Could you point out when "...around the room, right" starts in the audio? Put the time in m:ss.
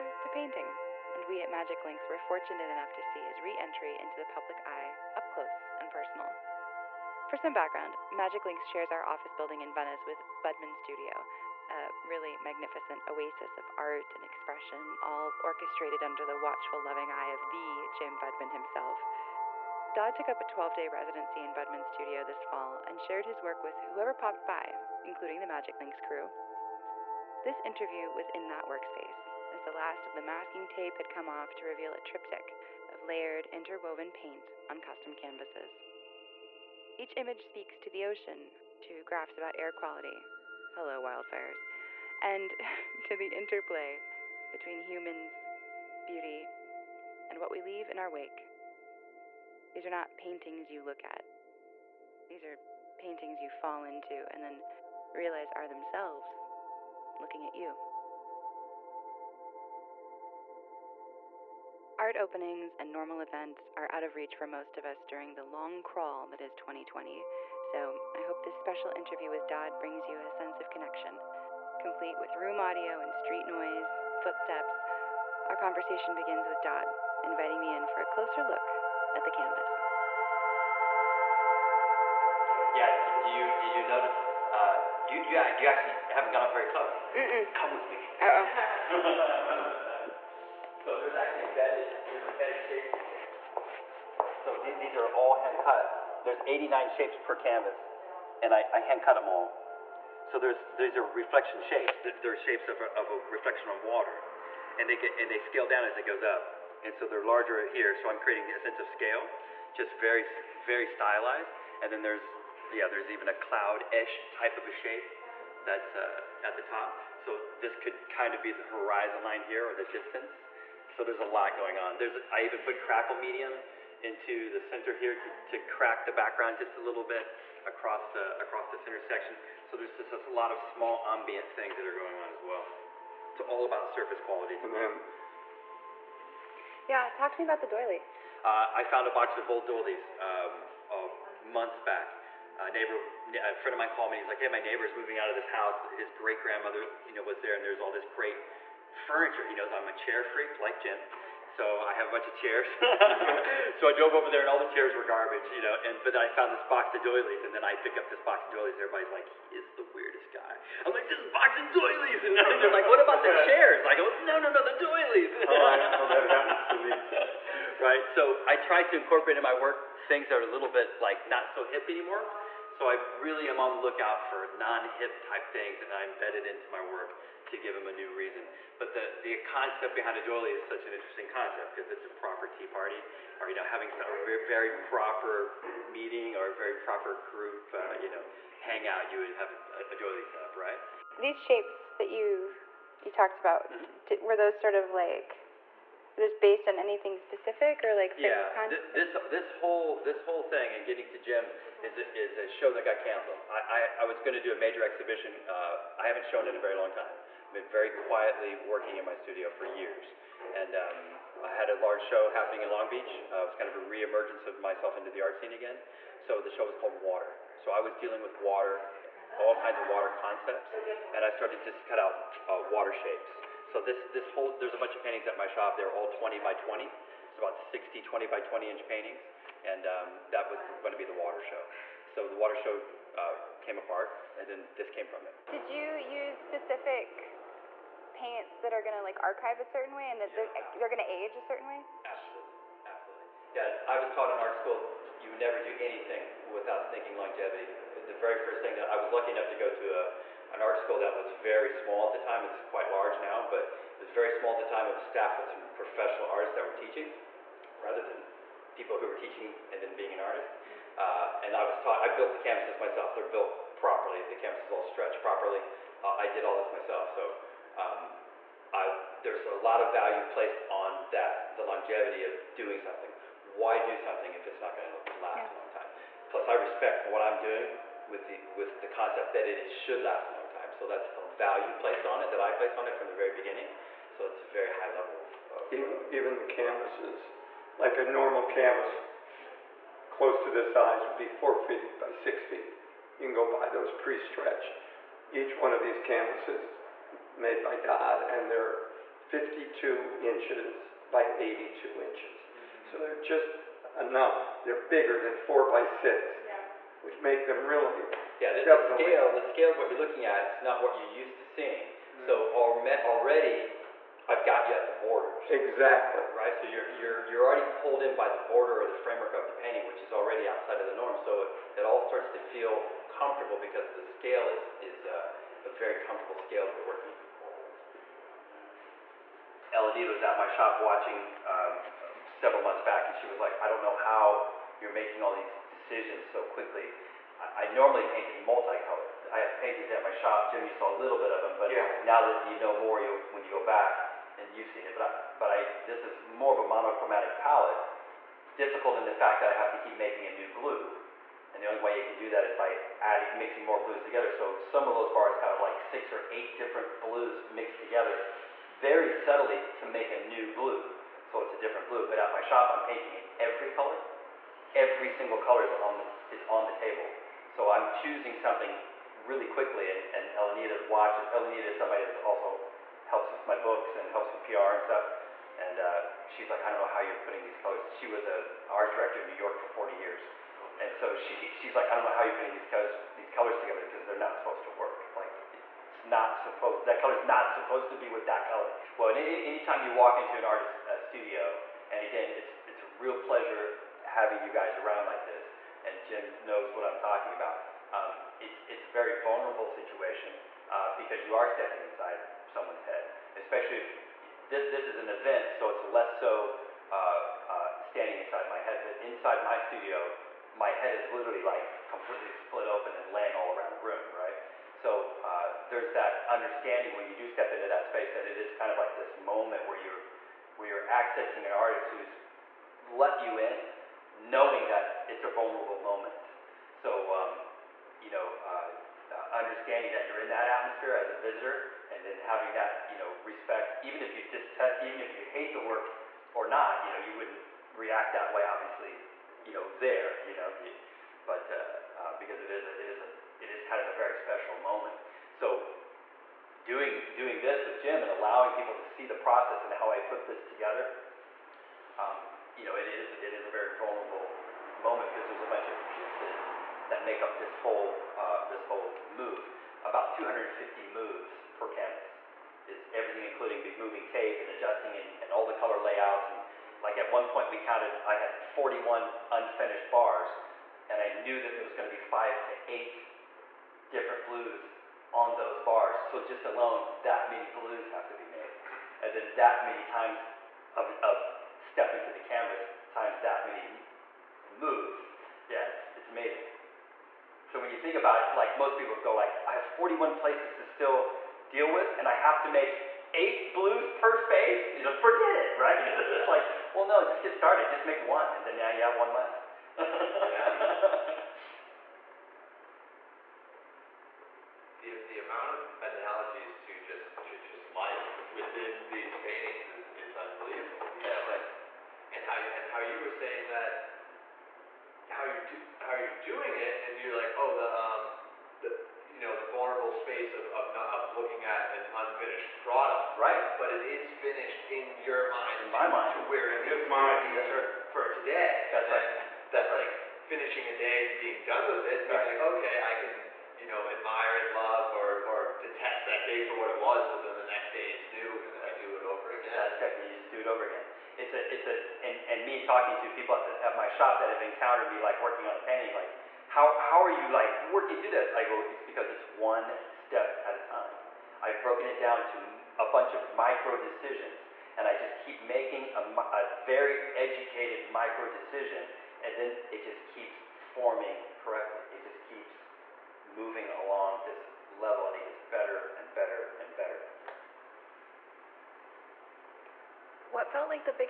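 6:53.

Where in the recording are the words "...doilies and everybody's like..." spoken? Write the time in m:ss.
2:38.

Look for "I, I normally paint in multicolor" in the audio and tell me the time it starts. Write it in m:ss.
5:37.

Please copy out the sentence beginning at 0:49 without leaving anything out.
These are not paintings you look at.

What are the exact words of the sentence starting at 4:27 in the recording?
So um, I, there's a lot of value placed on that, the longevity of doing something.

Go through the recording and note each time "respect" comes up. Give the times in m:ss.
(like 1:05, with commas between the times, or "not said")
4:36, 7:13.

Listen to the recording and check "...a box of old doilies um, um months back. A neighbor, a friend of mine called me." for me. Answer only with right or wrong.
right.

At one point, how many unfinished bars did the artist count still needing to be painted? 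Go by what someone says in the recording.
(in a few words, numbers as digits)
41.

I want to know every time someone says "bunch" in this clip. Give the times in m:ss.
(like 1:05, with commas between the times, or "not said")
2:32, 3:44, 7:35, 9:12.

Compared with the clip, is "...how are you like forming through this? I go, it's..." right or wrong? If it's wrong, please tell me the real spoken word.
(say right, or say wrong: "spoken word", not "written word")
wrong: "working", not "forming".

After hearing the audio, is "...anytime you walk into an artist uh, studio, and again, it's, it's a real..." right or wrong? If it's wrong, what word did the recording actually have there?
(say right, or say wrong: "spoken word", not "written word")
right.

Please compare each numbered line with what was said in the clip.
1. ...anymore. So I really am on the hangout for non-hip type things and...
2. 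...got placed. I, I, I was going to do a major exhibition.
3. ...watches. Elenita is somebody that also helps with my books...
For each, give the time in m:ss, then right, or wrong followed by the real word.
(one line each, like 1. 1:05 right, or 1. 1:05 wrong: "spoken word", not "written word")
1. 2:51 wrong: "lookout", not "hangout"
2. 3:22 wrong: "canceled", not "placed"
3. 6:10 right.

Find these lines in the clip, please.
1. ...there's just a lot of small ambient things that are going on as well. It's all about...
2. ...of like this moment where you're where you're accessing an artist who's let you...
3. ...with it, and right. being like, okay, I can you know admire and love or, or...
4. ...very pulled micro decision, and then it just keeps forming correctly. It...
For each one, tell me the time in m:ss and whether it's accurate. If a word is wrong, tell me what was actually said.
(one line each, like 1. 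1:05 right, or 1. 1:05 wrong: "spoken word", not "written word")
1. 2:09 right
2. 6:58 right
3. 8:51 right
4. 9:16 wrong: "educated", not "pulled".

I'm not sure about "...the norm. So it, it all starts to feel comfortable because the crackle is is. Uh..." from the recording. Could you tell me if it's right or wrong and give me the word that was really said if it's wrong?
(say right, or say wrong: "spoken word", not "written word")
wrong: "scale", not "crackle".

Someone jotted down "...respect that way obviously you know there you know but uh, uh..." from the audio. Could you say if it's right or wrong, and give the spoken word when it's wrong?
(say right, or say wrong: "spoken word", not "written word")
wrong: "react", not "respect".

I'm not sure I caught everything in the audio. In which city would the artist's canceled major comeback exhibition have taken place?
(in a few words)
Long Beach.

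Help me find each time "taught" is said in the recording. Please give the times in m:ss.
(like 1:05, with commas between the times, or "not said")
4:04, 4:21.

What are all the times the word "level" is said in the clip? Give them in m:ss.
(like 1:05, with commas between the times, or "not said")
4:44, 9:24.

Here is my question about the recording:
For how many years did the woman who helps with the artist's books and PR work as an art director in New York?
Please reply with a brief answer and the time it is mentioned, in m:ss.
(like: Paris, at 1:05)
40, at 6:19.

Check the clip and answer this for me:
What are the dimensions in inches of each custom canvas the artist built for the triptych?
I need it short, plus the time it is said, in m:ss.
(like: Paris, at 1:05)
52 by 82 inches, at 4:59.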